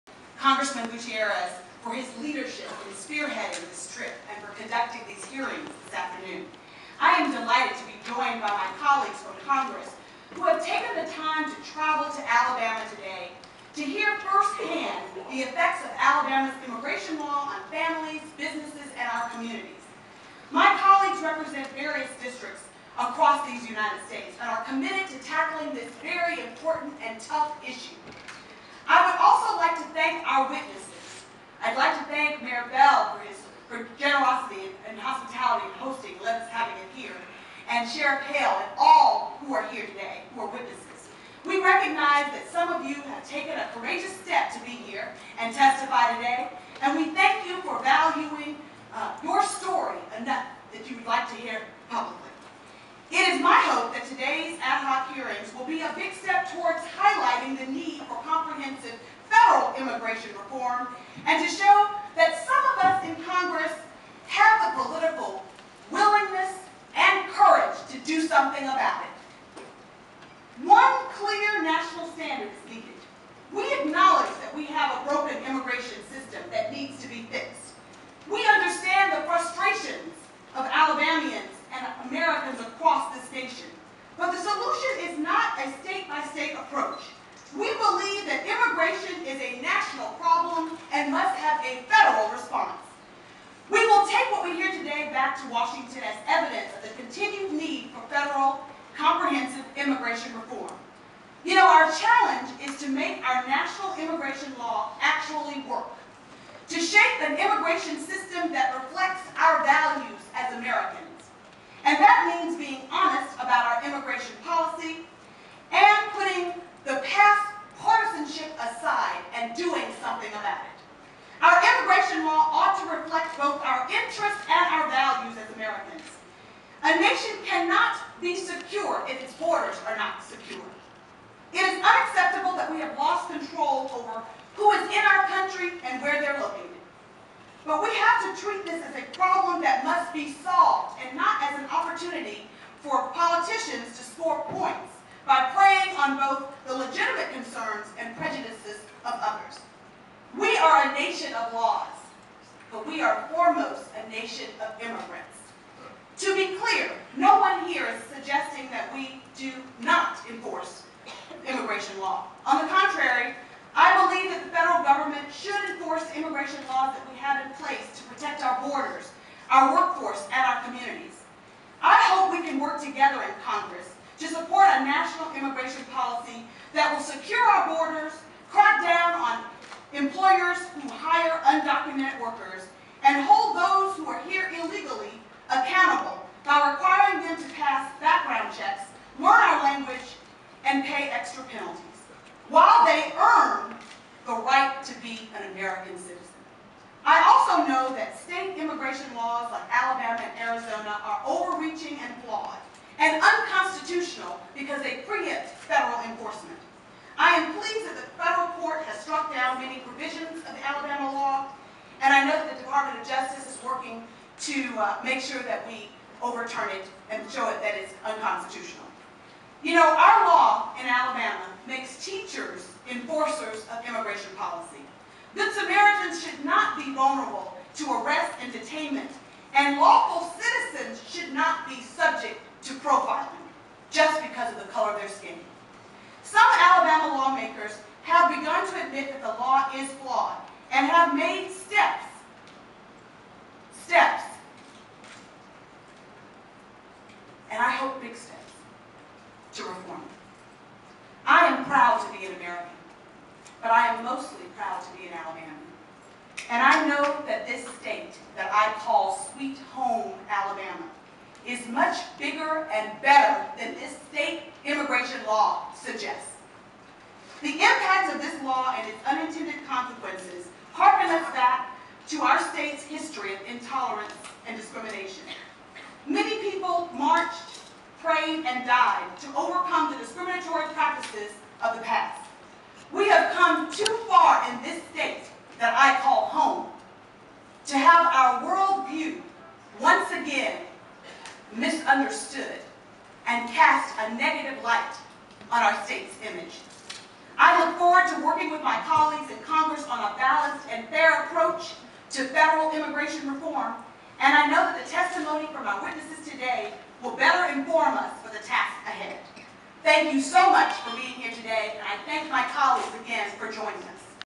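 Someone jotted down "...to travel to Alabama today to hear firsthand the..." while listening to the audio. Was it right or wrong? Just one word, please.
right.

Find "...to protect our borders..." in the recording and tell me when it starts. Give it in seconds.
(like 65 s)
167 s.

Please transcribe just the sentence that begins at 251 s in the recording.
I am proud to be an American, but I am mostly proud to be an Alabama.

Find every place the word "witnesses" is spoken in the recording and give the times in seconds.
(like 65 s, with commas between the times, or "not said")
30 s, 40 s, 305 s.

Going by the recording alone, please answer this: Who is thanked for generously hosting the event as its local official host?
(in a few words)
Mayor Bell.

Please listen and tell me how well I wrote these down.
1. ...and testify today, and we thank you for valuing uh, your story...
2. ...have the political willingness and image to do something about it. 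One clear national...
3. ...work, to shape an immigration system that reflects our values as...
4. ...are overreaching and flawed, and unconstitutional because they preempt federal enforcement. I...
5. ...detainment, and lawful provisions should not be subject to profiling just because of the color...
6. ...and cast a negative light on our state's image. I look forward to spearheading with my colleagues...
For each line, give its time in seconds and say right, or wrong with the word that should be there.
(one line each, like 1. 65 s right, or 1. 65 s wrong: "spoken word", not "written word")
1. 45 s right
2. 64 s wrong: "courage", not "image"
3. 105 s right
4. 201 s right
5. 228 s wrong: "citizens", not "provisions"
6. 293 s wrong: "working", not "spearheading".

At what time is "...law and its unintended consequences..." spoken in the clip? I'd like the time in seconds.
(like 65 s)
268 s.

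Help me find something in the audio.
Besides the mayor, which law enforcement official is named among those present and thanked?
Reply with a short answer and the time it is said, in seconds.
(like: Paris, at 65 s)
Sheriff Hale, at 37 s.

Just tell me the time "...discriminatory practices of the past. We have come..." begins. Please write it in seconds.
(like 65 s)
279 s.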